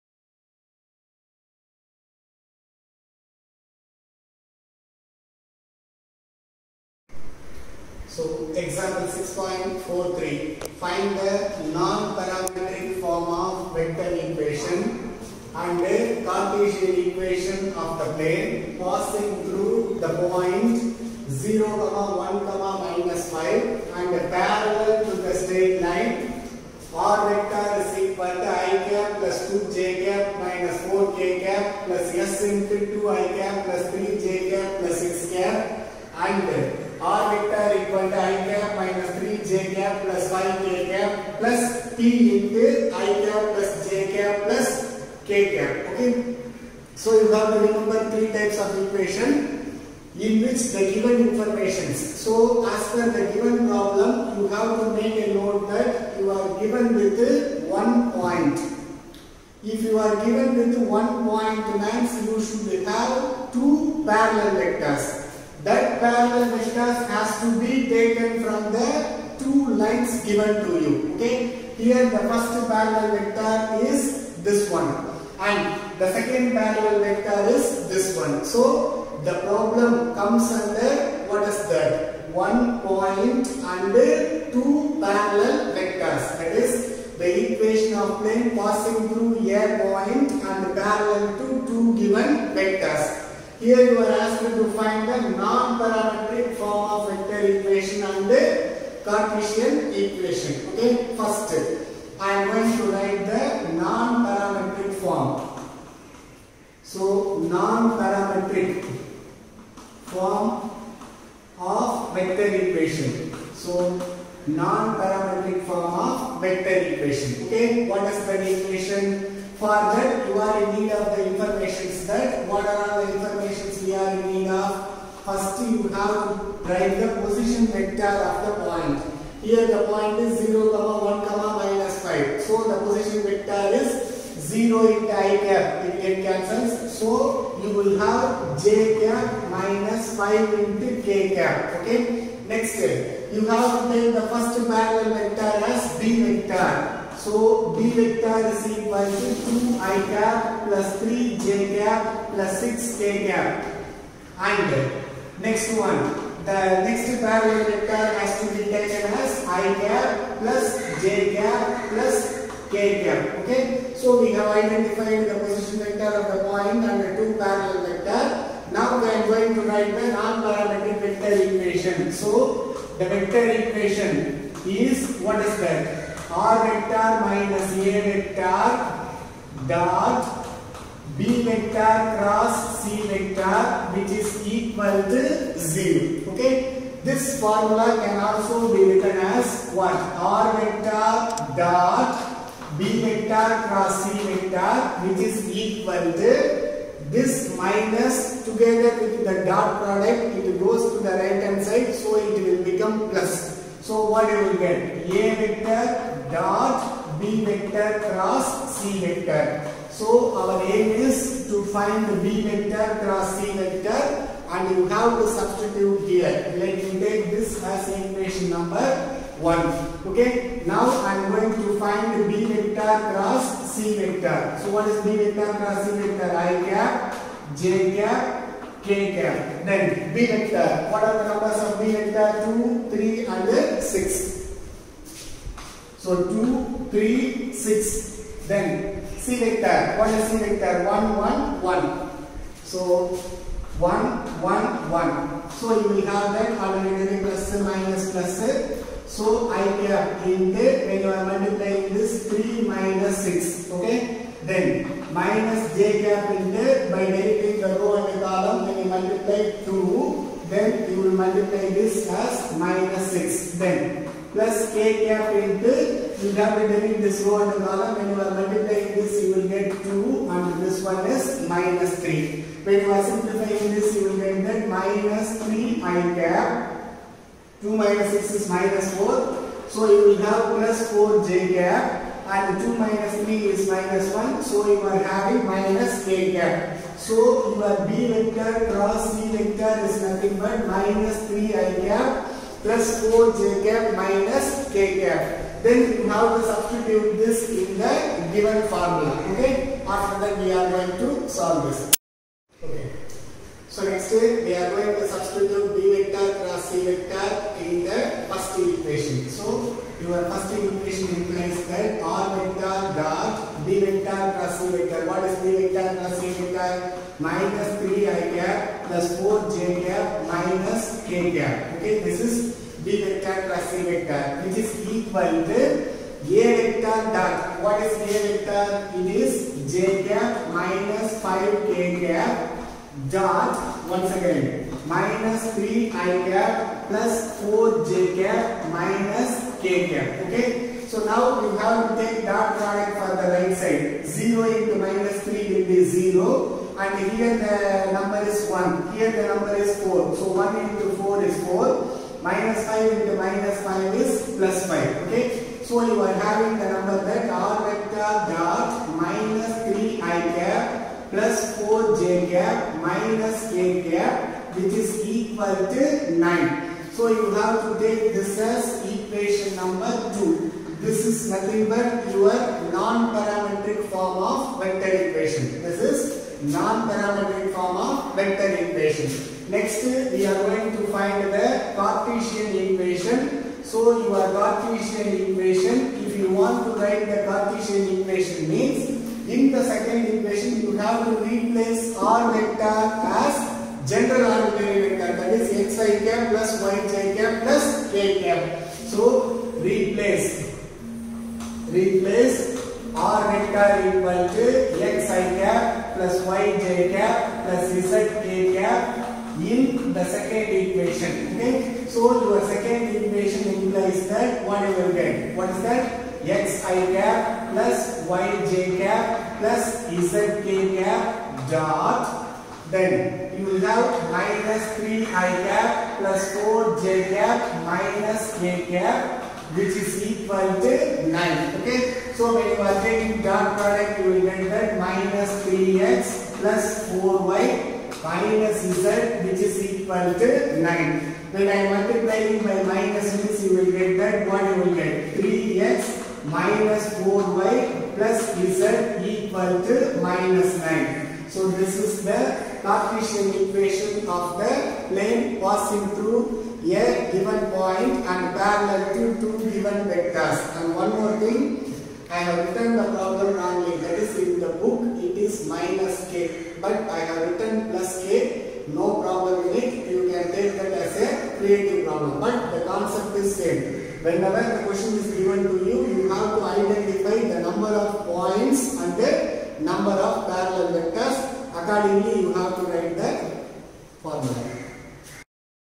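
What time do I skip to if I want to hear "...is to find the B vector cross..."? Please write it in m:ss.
3:30.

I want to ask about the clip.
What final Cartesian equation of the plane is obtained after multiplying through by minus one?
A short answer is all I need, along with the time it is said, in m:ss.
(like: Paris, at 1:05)
3x - 4y + z = -9, at 7:25.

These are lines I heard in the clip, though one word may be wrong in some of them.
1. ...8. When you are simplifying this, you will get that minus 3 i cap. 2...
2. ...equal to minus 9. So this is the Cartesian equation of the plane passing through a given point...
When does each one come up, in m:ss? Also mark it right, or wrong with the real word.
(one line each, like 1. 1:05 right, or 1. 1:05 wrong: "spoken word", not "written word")
1. 4:32 wrong: "3", not "8"
2. 7:29 right.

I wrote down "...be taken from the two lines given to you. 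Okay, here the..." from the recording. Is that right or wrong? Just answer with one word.
right.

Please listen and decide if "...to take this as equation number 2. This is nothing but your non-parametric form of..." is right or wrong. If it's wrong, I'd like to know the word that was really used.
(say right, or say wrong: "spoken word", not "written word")
right.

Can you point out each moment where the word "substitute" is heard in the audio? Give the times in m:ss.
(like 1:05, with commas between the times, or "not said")
3:35, 4:56, 5:05.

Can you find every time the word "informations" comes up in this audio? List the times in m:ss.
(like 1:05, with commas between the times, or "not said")
0:51, 2:01.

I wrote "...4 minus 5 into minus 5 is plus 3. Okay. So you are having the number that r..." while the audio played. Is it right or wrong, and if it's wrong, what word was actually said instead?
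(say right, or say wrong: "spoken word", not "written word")
wrong: "5", not "3".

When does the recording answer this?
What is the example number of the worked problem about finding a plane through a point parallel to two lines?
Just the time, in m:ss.
0:09.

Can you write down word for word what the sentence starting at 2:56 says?
R vector minus A vector dot B vector cross C vector which is equal to 0.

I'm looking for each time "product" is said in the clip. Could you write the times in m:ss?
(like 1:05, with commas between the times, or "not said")
3:19, 5:42, 7:13.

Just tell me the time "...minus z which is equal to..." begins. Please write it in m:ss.
7:18.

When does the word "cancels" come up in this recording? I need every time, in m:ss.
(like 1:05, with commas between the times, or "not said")
2:16.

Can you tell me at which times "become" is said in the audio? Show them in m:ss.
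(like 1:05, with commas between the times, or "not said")
3:22.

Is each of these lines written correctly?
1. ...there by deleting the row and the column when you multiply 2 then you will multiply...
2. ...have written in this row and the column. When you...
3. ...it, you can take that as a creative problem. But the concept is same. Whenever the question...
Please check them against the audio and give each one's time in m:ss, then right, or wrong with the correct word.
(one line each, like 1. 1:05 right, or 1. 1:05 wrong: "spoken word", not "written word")
1. 4:16 right
2. 4:26 right
3. 7:49 right.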